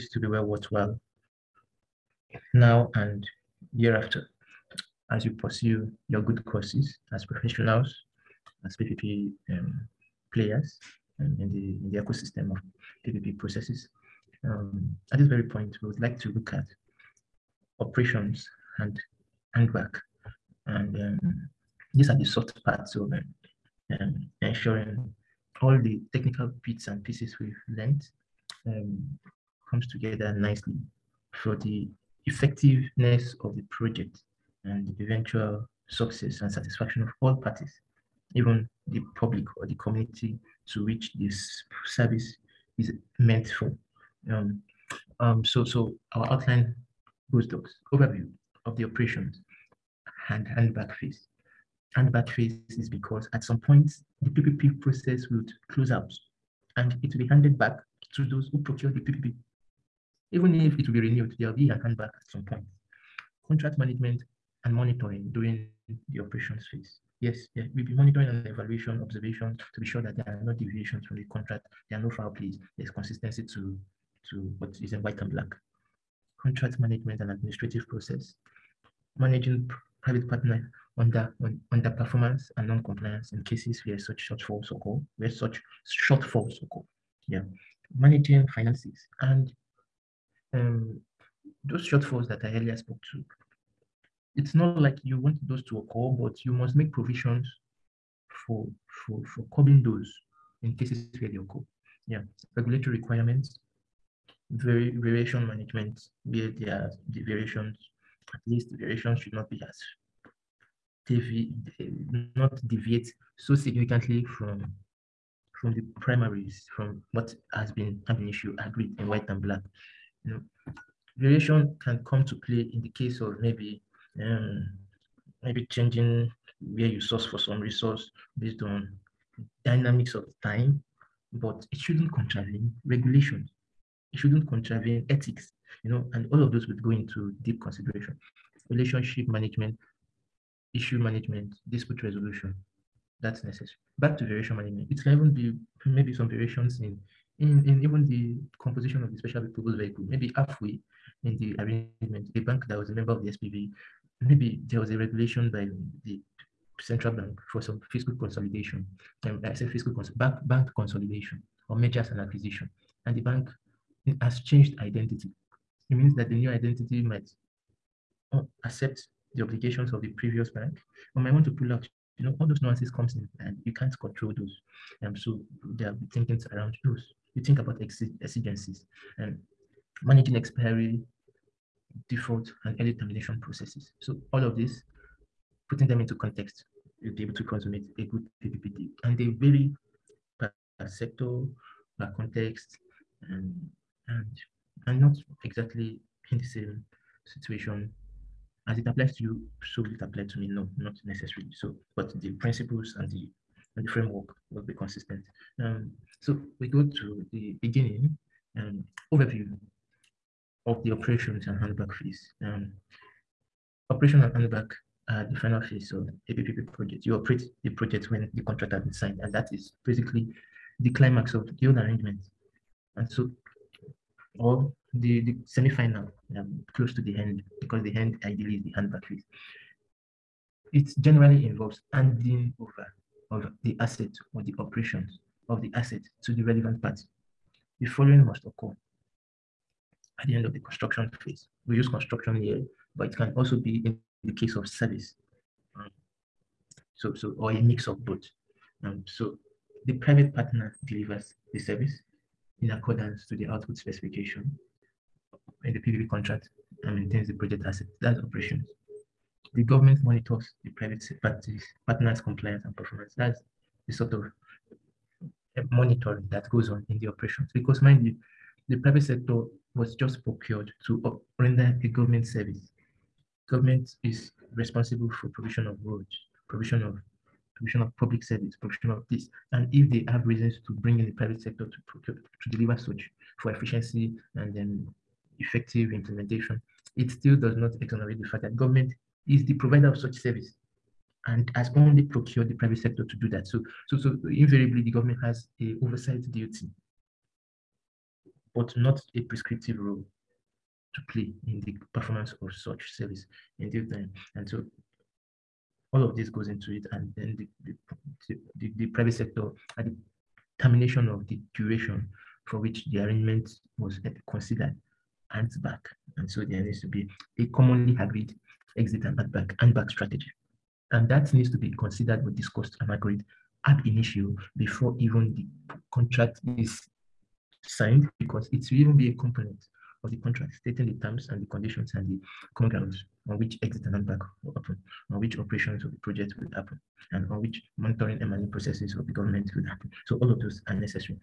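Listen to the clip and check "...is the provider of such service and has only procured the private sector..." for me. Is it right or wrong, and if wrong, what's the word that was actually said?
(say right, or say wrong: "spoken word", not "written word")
right.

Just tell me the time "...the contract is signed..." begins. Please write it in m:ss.
5:25.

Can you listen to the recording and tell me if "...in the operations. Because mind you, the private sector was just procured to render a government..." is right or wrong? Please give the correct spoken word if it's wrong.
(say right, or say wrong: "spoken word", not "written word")
right.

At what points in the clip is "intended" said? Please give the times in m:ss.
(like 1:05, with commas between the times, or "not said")
not said.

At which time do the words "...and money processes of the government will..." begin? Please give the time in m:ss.
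5:38.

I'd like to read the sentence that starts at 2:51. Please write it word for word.
or might want to pull out, you know, all those nuances comes in and you can't control those.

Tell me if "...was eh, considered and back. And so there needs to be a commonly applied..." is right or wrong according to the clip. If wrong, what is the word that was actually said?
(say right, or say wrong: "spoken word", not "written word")
wrong: "agreed", not "applied".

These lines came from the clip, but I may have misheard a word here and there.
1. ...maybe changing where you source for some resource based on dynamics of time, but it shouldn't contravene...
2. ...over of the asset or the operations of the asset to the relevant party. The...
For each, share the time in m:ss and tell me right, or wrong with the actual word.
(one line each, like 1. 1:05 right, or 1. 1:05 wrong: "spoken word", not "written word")
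1. 2:05 right
2. 3:52 right.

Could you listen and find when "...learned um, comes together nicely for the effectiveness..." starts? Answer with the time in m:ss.
0:27.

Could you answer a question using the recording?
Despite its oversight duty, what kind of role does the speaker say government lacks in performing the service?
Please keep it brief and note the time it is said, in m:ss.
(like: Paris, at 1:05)
prescriptive role, at 4:59.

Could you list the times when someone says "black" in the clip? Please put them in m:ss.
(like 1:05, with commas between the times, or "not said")
1:15, 1:59.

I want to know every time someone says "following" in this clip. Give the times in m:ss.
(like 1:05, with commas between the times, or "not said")
3:57.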